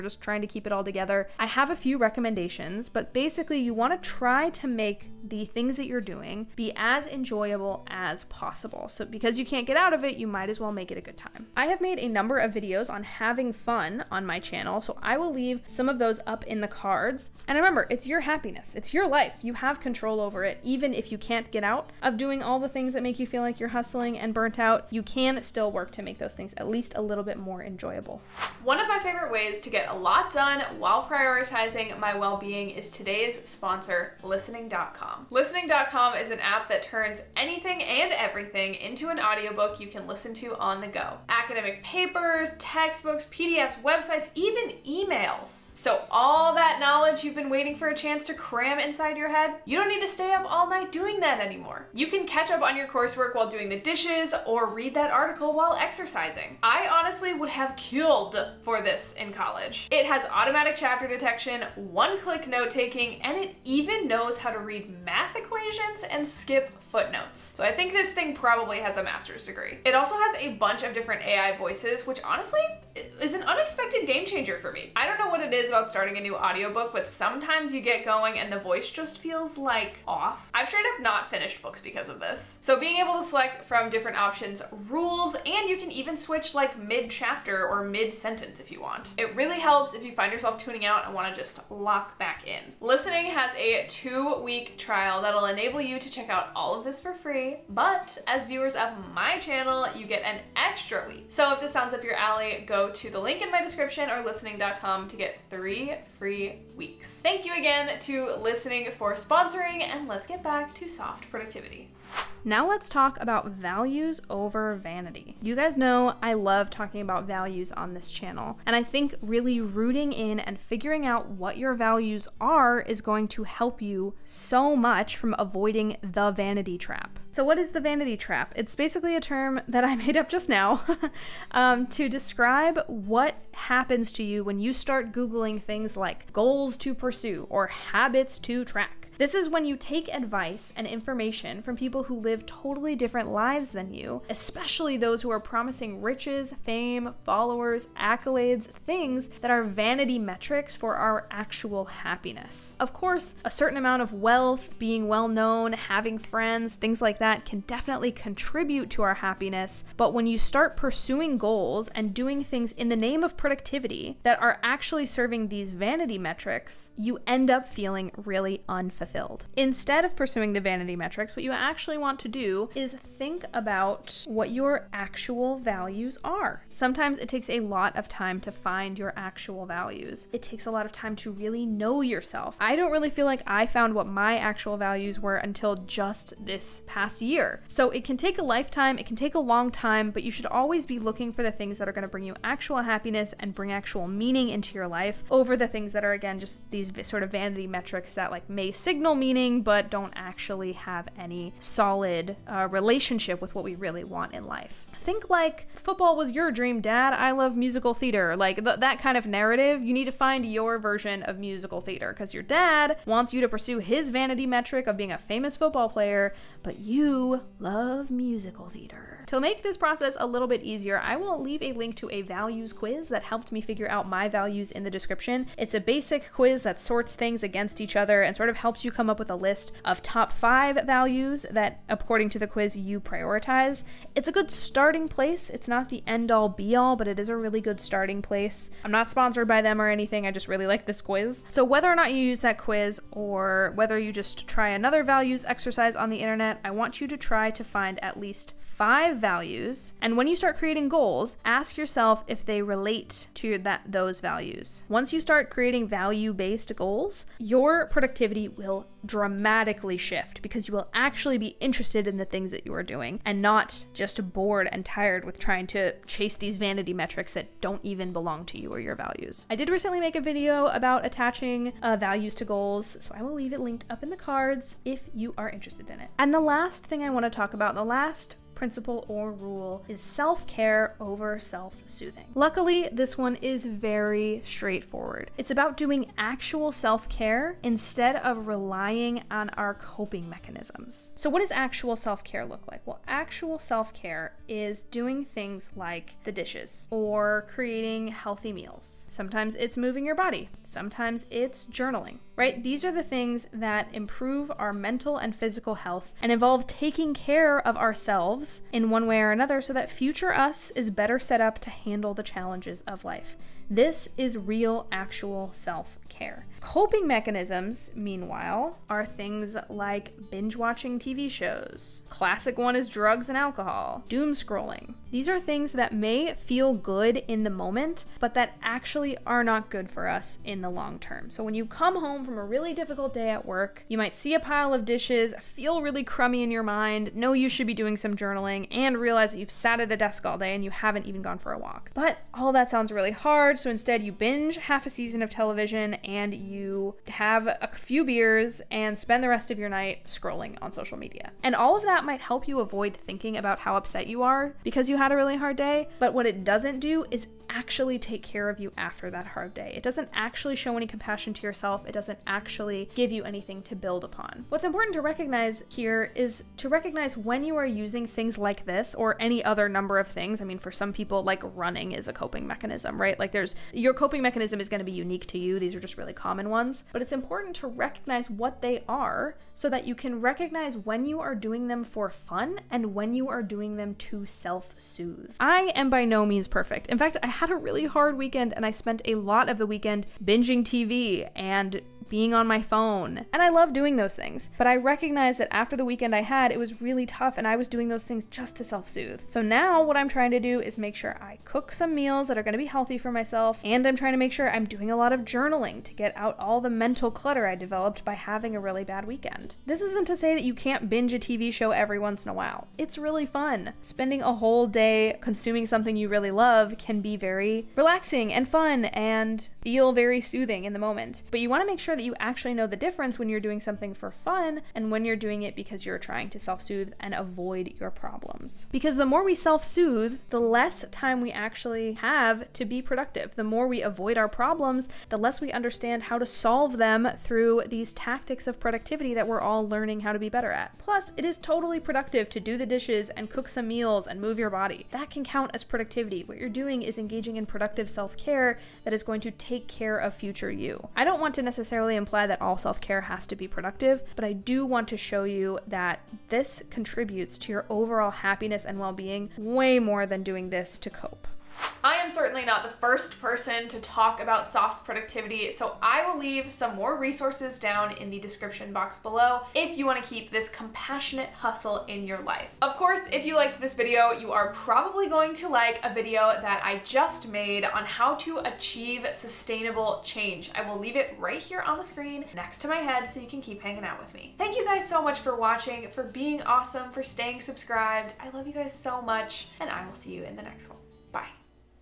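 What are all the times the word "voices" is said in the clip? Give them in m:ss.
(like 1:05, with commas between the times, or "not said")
1:11, 1:18.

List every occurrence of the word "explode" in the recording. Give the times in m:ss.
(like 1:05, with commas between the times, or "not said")
not said.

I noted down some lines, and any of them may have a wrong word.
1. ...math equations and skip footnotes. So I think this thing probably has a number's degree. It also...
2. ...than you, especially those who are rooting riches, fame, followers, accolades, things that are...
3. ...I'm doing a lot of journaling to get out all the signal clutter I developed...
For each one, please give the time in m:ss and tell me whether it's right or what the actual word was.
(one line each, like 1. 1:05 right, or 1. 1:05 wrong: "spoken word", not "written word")
1. 1:05 wrong: "master", not "number"
2. 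2:23 wrong: "promising", not "rooting"
3. 6:44 wrong: "mental", not "signal".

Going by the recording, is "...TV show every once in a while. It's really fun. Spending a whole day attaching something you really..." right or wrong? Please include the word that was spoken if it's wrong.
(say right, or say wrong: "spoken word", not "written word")
wrong: "consuming", not "attaching".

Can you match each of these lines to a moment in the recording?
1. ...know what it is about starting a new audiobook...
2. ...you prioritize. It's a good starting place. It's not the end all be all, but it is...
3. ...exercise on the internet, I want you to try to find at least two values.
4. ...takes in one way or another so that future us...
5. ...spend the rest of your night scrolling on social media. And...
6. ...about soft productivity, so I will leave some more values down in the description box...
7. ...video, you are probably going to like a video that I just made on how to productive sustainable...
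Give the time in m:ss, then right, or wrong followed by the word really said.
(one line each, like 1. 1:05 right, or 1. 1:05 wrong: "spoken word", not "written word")
1. 1:15 right
2. 3:52 right
3. 4:05 wrong: "five", not "two"
4. 5:07 wrong: "ourselves", not "takes"
5. 5:48 right
6. 7:44 wrong: "resources", not "values"
7. 7:53 wrong: "achieve", not "productive".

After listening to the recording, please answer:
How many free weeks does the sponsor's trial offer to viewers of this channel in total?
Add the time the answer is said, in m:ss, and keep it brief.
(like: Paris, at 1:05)
3, at 1:45.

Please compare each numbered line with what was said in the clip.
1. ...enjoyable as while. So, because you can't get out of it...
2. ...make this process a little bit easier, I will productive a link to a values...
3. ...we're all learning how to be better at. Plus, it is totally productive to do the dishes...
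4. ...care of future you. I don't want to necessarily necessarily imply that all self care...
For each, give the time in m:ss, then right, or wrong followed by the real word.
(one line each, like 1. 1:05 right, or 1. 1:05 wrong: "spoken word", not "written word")
1. 0:07 wrong: "possible", not "while"
2. 3:39 wrong: "leave", not "productive"
3. 7:19 right
4. 7:29 right.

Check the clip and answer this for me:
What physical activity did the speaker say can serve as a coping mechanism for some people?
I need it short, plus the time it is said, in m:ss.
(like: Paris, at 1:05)
running, at 6:11.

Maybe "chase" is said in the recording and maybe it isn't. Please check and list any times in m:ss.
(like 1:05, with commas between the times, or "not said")
4:26.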